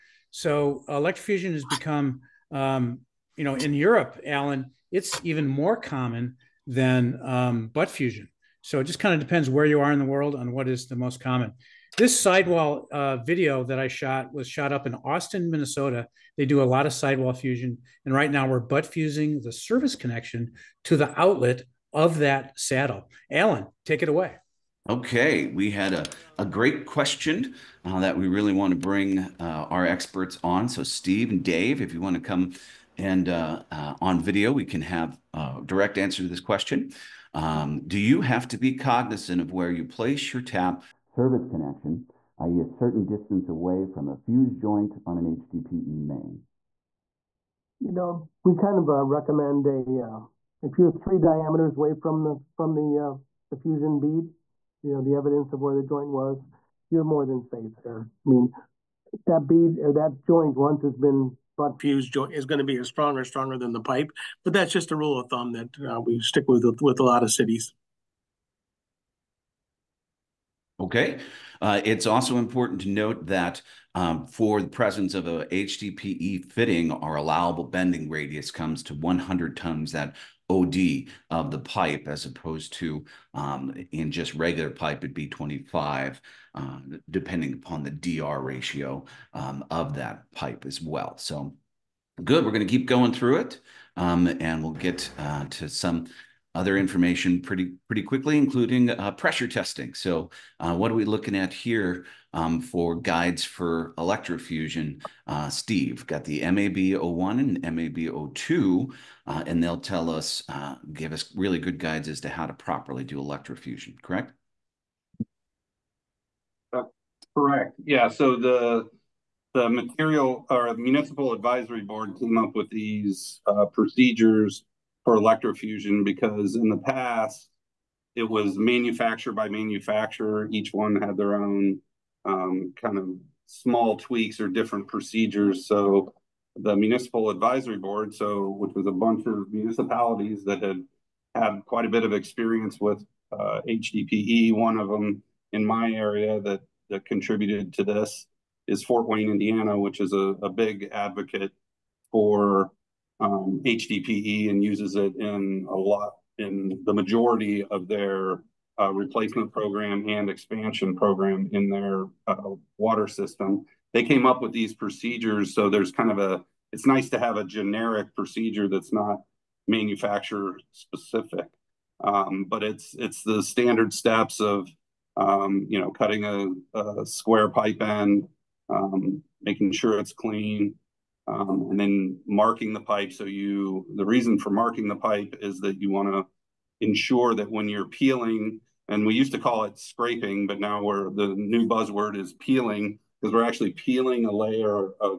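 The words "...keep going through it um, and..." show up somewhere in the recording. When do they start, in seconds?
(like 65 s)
92 s.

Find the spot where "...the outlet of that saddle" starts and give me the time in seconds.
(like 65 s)
20 s.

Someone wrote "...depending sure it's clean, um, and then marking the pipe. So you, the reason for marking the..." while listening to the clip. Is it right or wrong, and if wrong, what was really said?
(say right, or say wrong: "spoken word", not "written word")
wrong: "making", not "depending".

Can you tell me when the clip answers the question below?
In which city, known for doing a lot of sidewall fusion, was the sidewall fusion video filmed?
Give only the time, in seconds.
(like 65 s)
14 s.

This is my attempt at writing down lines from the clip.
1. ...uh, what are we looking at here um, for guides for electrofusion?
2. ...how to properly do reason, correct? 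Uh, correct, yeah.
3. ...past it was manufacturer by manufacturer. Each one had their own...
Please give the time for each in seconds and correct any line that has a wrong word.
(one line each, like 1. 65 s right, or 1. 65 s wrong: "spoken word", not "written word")
1. 100 s right
2. 112 s wrong: "electrofusion", not "reason"
3. 126 s right.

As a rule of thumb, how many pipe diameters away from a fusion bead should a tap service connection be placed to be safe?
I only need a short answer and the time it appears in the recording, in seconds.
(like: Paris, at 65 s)
3, at 50 s.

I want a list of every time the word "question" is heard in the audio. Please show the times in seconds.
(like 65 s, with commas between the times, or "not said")
26 s, 36 s.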